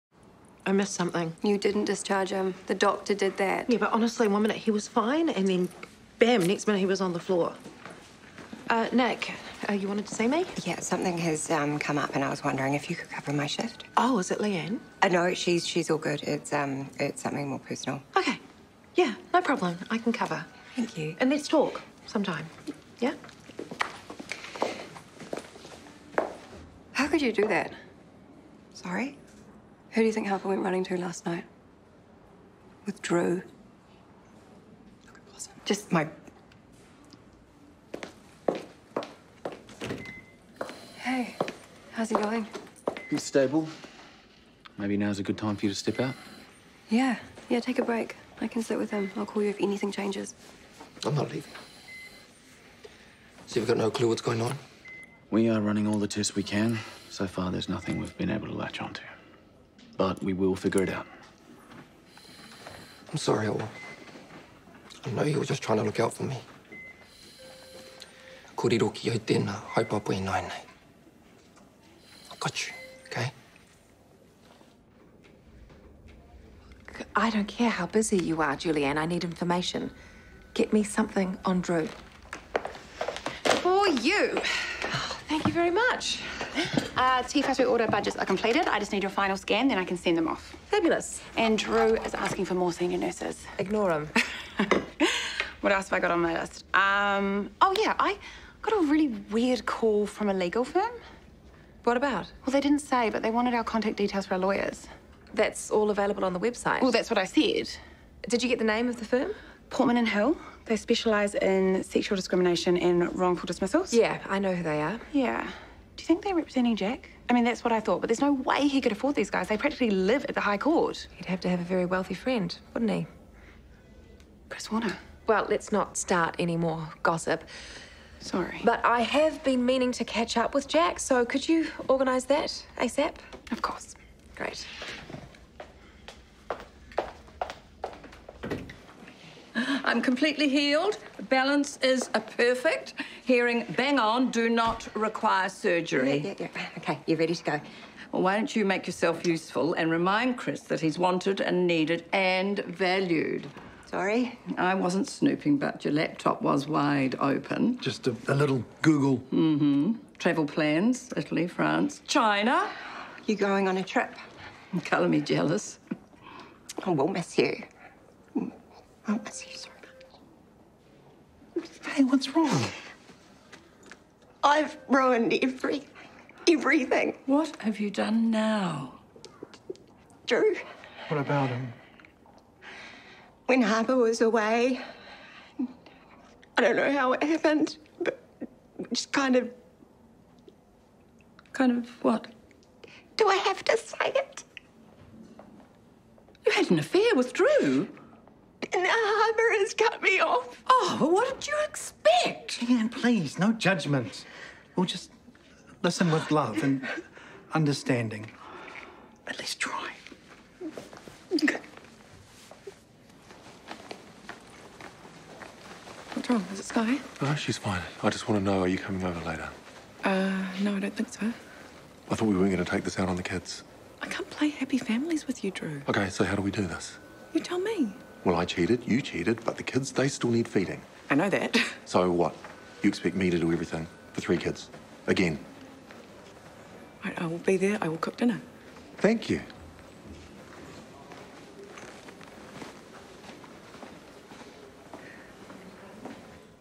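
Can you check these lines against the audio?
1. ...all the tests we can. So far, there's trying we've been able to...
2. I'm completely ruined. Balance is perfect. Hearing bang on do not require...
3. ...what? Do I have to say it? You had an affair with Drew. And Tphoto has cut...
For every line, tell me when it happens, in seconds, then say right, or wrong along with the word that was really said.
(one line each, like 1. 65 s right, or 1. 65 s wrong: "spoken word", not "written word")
1. 55 s wrong: "nothing", not "trying"
2. 139 s wrong: "healed", not "ruined"
3. 192 s wrong: "Harper", not "Tphoto".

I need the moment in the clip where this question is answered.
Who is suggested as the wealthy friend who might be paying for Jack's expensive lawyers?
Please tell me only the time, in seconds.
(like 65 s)
124 s.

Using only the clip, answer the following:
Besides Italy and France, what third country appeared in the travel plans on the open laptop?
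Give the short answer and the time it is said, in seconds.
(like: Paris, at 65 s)
China, at 162 s.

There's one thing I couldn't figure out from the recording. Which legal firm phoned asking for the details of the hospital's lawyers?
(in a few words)
Portman and Hill.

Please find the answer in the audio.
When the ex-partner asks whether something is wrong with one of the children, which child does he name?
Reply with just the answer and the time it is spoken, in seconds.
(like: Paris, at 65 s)
Sky, at 216 s.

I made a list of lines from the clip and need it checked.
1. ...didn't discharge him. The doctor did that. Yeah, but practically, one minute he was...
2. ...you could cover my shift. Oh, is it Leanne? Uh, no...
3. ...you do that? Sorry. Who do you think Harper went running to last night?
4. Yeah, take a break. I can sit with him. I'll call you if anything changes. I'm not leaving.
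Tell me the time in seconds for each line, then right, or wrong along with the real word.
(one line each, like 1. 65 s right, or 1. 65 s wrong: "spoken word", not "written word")
1. 1 s wrong: "honestly", not "practically"
2. 12 s right
3. 27 s right
4. 47 s right.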